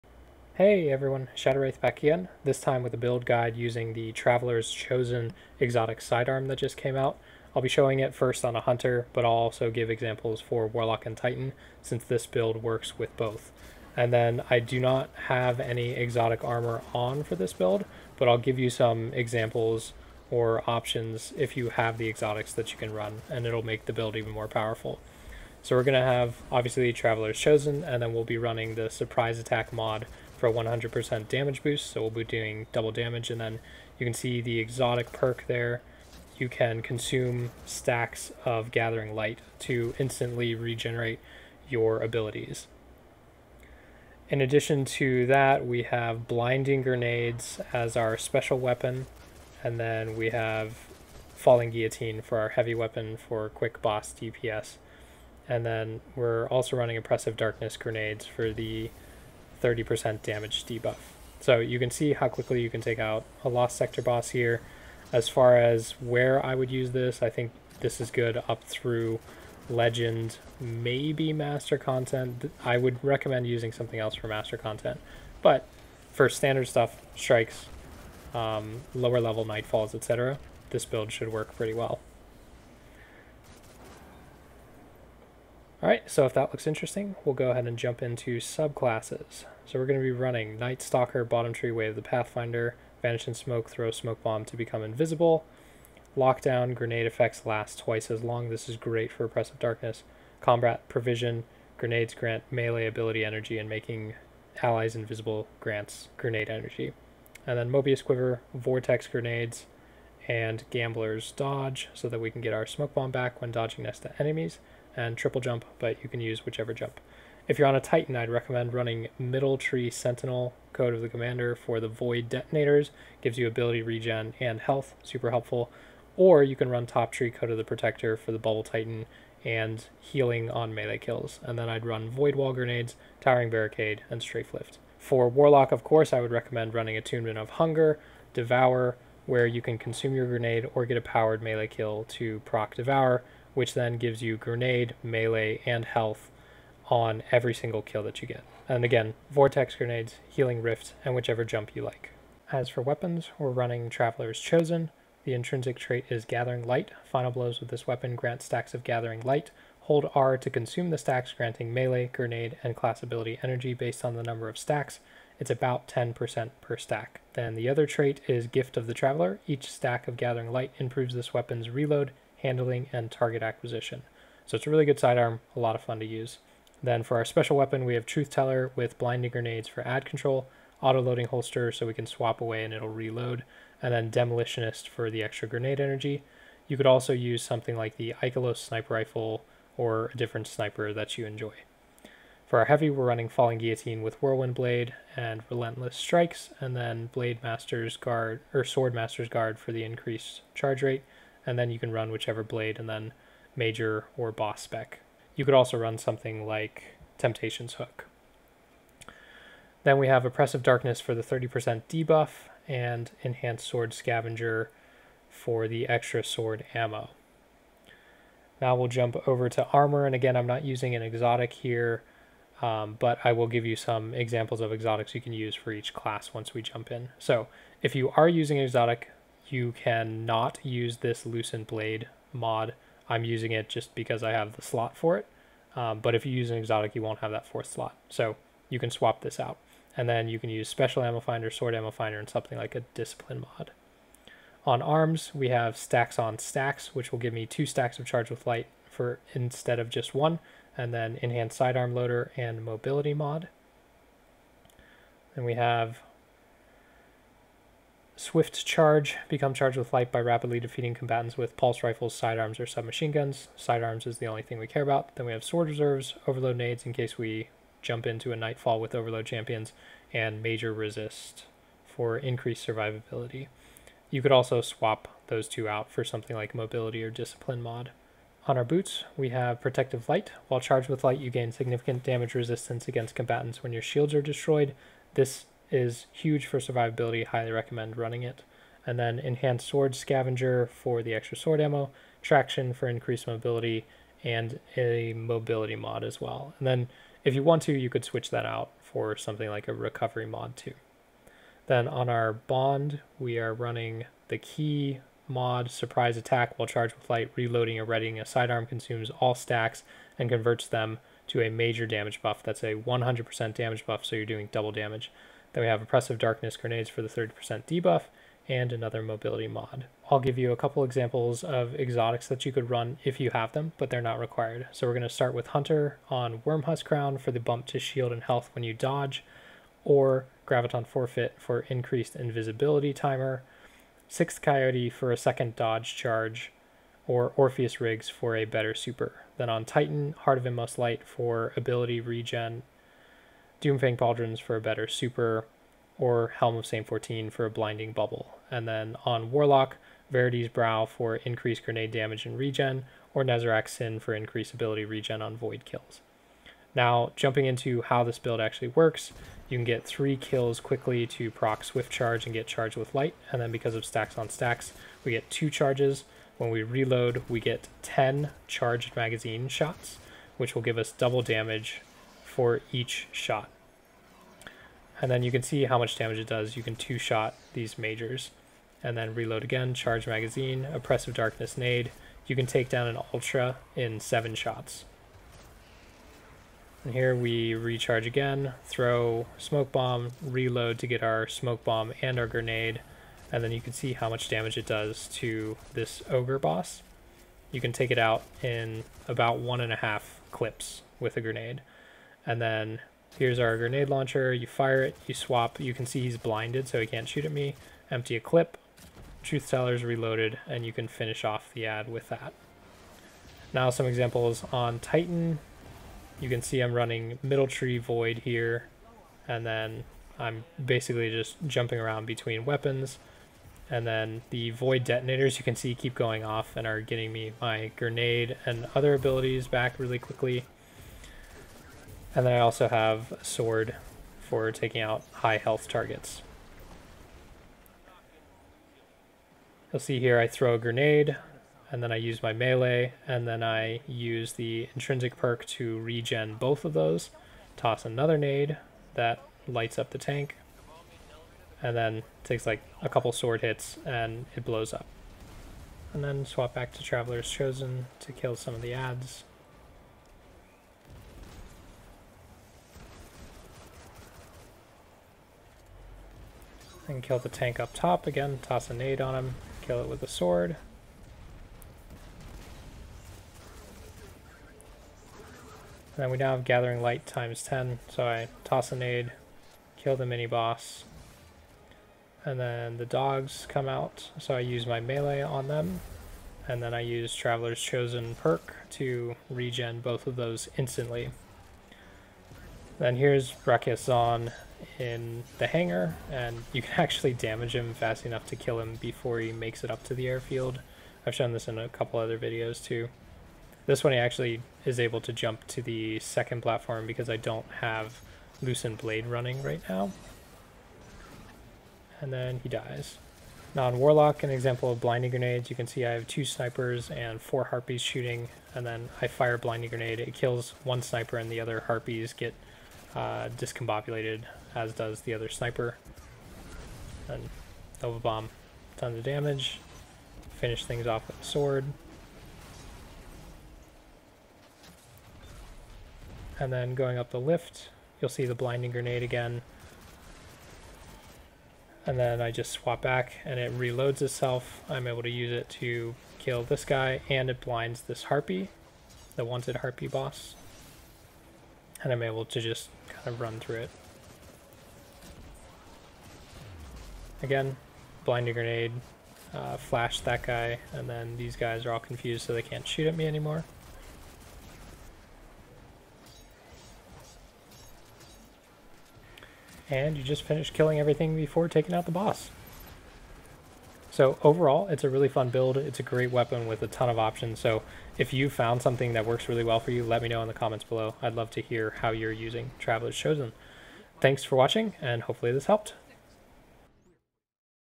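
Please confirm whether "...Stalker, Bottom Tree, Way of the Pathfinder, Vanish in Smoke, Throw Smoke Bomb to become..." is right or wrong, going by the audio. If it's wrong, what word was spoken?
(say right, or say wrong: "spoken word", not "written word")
right.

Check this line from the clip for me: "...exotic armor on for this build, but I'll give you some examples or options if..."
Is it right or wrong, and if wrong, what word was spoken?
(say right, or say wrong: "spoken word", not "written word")
right.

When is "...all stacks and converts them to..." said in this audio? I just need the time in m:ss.
5:09.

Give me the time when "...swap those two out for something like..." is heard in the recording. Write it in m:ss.
4:34.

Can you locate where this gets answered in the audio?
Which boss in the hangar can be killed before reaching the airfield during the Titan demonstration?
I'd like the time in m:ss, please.
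8:13.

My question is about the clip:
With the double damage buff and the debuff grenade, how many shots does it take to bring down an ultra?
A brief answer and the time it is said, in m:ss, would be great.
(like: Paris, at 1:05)
7, at 6:23.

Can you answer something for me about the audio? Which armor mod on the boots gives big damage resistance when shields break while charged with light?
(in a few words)
Protective Light.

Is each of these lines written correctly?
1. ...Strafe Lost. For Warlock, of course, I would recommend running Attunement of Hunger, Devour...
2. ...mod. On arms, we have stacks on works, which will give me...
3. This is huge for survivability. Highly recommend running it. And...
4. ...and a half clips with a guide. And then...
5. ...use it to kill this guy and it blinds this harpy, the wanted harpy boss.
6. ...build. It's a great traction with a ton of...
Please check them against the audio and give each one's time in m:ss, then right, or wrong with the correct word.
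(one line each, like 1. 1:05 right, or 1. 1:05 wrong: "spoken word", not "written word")
1. 2:14 wrong: "Lift", not "Lost"
2. 4:03 wrong: "stacks", not "works"
3. 4:45 right
4. 6:39 wrong: "grenade", not "guide"
5. 9:05 right
6. 9:35 wrong: "weapon", not "traction".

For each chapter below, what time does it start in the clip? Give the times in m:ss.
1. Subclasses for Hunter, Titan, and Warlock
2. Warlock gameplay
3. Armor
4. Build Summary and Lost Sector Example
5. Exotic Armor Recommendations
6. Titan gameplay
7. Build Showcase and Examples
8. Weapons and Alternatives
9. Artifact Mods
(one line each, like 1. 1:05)
1. 1:24
2. 8:32
3. 3:38
4. 0:12
5. 5:20
6. 6:52
7. 5:55
8. 2:32
9. 3:28.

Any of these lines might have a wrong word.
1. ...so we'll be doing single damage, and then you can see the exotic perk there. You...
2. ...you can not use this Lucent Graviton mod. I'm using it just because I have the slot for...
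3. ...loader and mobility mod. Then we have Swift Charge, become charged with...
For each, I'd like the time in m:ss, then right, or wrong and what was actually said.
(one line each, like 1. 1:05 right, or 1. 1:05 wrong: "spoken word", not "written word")
1. 0:31 wrong: "double", not "single"
2. 3:49 wrong: "Blade", not "Graviton"
3. 4:11 right.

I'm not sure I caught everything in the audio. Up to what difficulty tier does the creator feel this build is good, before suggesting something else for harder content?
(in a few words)
Legend.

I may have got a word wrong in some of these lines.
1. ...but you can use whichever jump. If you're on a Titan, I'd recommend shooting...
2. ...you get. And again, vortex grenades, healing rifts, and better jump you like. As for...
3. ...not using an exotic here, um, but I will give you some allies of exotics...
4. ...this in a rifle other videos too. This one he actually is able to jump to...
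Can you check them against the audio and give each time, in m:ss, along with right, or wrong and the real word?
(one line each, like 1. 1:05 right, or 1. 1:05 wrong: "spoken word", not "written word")
1. 1:55 wrong: "running", not "shooting"
2. 2:28 wrong: "whichever", not "better"
3. 3:40 wrong: "examples", not "allies"
4. 8:21 wrong: "couple", not "rifle".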